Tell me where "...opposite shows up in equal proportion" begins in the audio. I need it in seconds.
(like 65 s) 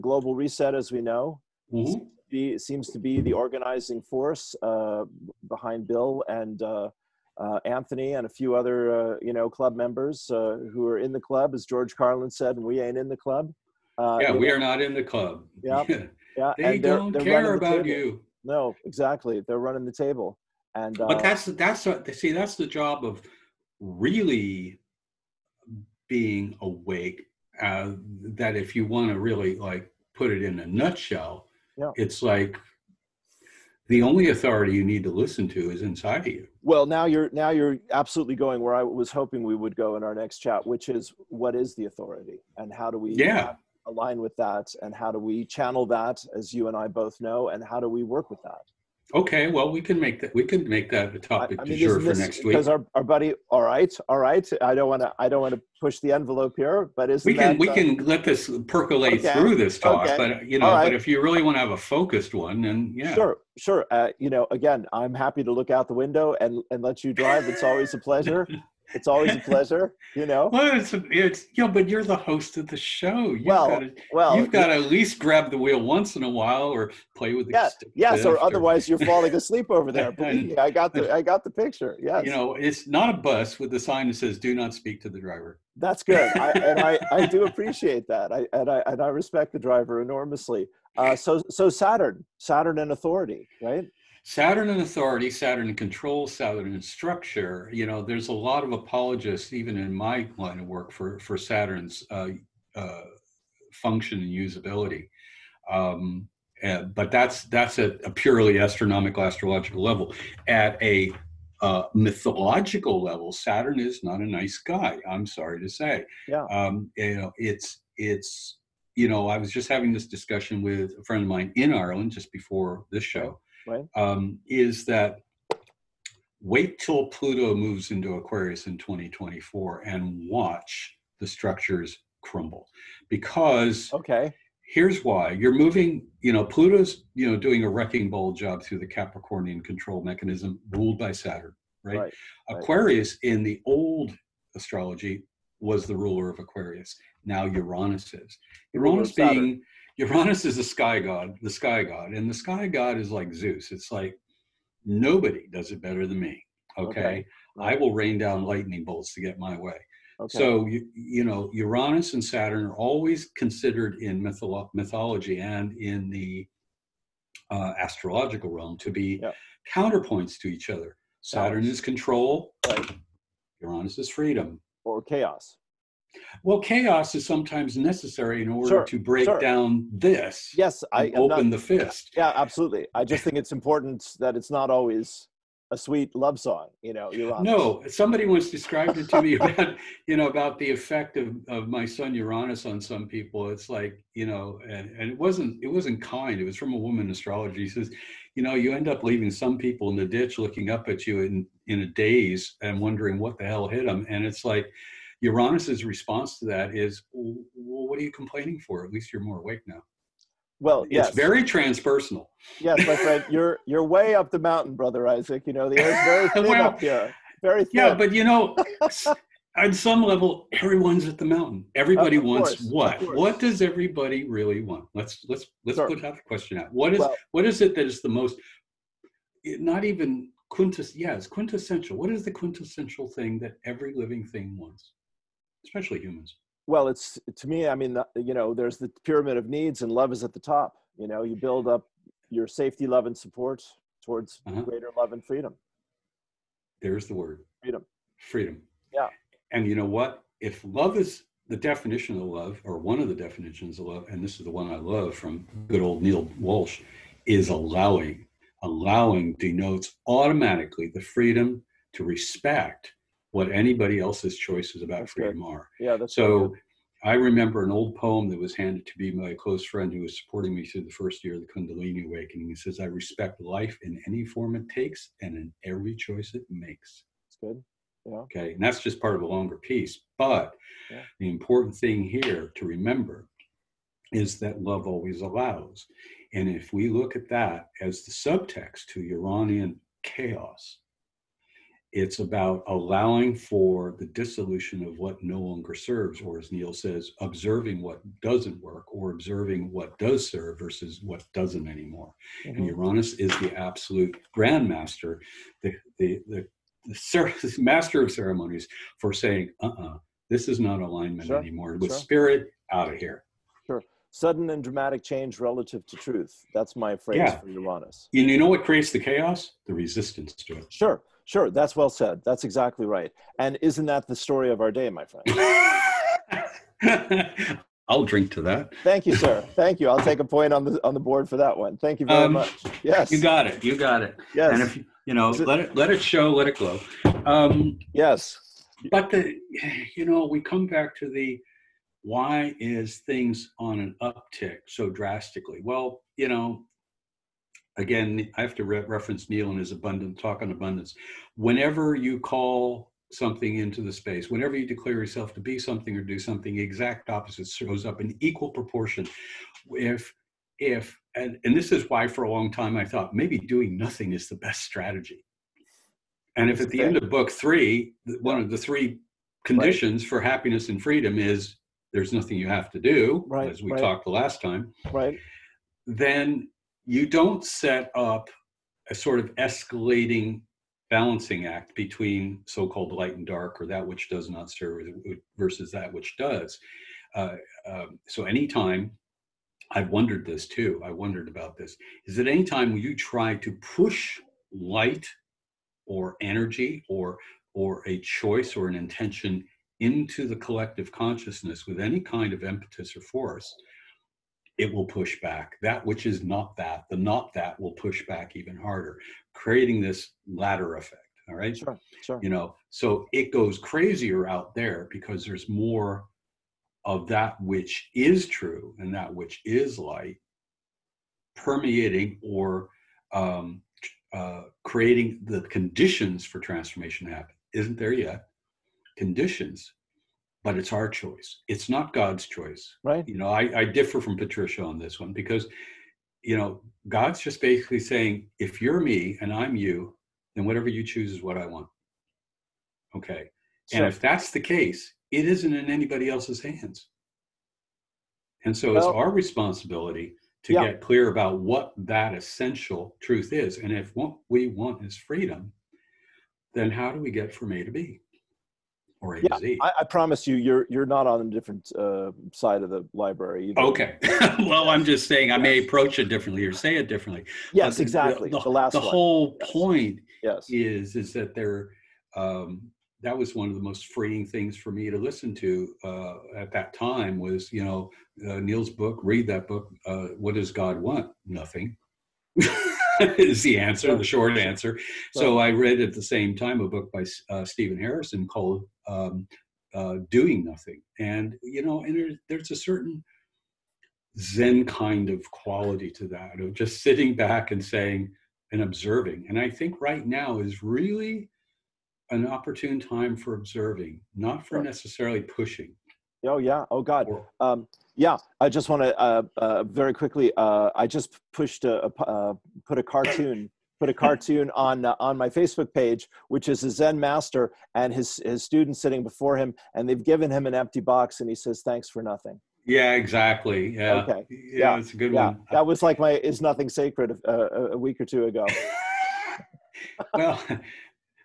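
357 s.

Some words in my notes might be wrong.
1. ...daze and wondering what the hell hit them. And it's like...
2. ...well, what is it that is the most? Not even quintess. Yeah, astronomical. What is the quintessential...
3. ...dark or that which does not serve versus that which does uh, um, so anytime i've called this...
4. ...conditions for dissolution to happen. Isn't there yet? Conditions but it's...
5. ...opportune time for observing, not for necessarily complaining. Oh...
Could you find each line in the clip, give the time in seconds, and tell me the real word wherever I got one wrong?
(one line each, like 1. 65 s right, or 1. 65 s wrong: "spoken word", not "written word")
1. 201 s right
2. 226 s wrong: "quintessential", not "astronomical"
3. 383 s wrong: "wondered", not "called"
4. 425 s wrong: "transformation", not "dissolution"
5. 502 s wrong: "pushing", not "complaining".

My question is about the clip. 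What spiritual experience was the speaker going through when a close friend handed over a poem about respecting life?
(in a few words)
Kundalini awakening.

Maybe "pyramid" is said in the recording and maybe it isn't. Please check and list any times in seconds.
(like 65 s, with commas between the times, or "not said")
239 s.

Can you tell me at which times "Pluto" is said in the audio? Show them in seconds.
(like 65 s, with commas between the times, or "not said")
127 s, 136 s.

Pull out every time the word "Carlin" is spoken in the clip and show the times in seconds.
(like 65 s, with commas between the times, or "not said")
11 s.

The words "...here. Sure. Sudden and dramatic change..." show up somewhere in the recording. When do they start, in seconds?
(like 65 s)
312 s.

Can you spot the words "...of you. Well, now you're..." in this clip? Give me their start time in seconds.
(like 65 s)
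36 s.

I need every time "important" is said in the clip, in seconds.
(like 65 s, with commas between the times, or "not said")
183 s, 281 s.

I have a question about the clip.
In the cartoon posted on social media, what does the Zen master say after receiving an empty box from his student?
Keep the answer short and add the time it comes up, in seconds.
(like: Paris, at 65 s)
Thanks for nothing, at 521 s.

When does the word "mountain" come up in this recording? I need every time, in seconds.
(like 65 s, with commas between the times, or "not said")
214 s, 221 s.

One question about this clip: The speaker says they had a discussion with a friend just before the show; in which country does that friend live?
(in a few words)
Ireland.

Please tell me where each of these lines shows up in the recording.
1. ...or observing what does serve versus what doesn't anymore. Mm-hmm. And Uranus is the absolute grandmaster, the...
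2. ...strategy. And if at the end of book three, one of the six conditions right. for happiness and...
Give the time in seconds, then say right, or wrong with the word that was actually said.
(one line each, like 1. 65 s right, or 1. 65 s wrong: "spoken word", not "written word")
1. 298 s right
2. 364 s wrong: "three", not "six".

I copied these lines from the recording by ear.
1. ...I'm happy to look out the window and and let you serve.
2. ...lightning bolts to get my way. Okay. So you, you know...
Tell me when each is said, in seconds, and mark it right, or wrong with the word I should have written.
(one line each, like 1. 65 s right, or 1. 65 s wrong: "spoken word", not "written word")
1. 64 s wrong: "drive", not "serve"
2. 158 s right.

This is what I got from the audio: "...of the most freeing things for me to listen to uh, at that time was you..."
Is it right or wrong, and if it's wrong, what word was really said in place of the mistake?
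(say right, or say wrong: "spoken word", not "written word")
right.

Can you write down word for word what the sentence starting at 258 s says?
Allowing denotes automatically the freedom to respect what anybody else's choices about freedom good.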